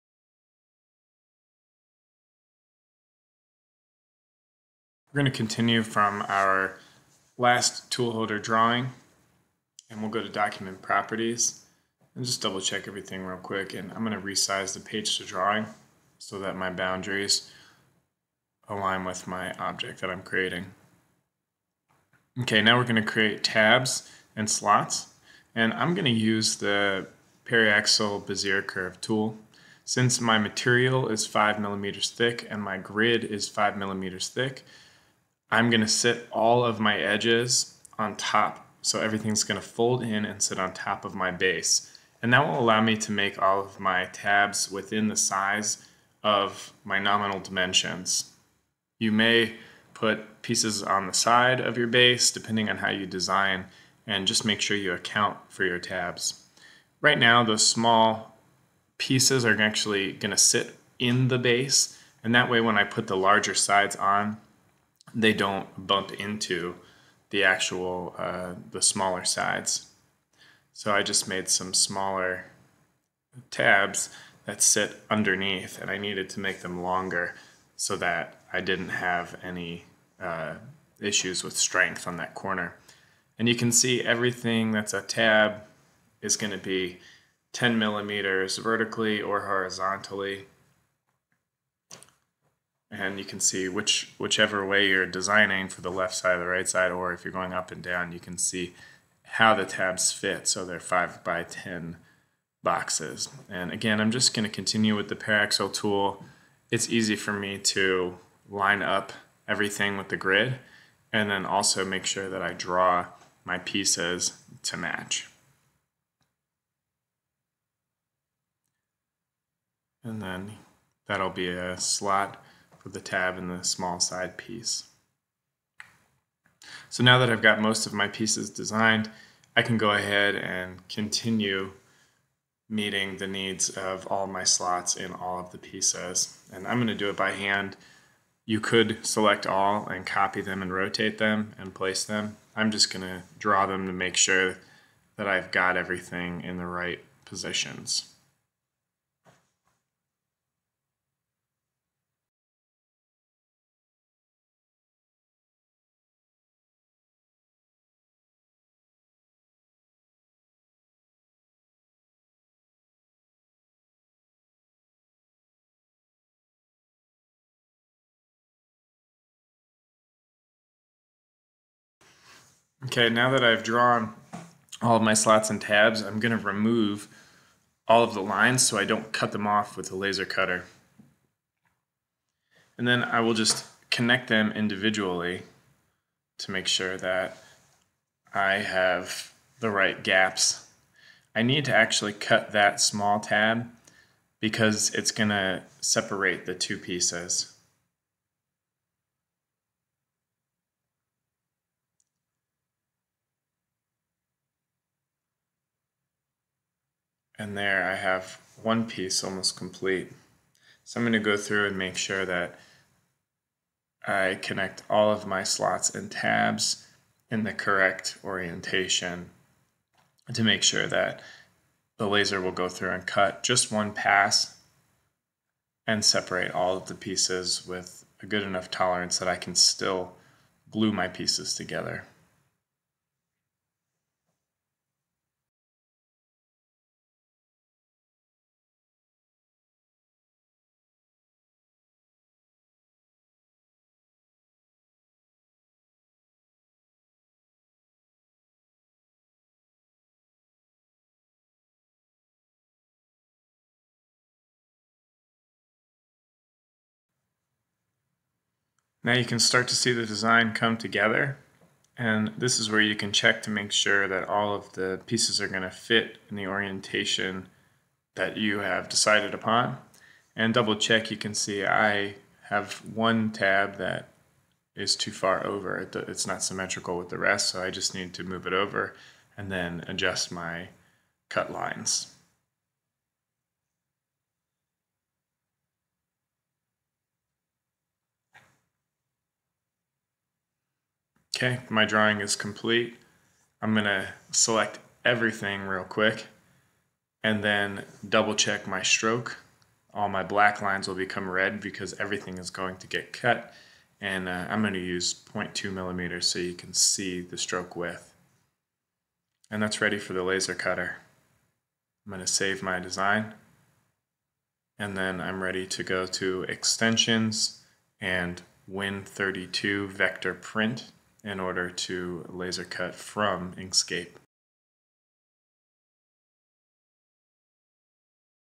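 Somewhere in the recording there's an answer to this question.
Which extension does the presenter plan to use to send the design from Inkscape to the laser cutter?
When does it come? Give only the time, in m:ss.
5:18.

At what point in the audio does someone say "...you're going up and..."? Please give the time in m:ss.
1:37.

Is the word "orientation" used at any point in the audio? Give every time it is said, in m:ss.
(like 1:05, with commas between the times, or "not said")
3:38, 4:26.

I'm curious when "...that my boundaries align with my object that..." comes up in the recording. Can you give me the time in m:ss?
0:16.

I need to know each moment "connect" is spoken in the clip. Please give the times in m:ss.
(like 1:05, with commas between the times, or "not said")
3:03, 3:34.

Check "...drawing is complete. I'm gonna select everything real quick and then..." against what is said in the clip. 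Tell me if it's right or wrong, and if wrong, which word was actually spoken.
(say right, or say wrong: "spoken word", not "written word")
right.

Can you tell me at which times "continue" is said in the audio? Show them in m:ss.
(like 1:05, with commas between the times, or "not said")
0:05, 1:44, 2:10.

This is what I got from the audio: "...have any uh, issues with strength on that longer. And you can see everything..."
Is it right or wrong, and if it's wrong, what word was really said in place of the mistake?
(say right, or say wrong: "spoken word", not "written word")
wrong: "corner", not "longer".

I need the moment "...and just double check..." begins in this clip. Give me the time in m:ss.
0:12.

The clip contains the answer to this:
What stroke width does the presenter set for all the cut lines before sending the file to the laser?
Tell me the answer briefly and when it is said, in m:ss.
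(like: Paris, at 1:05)
0.2 millimeters, at 5:05.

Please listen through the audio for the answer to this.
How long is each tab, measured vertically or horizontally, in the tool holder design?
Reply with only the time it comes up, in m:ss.
1:27.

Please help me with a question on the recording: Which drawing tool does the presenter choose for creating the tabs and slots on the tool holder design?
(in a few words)
Paraxial Bezier curve tool.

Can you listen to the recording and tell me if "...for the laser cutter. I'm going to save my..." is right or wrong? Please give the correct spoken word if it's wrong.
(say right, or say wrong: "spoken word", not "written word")
right.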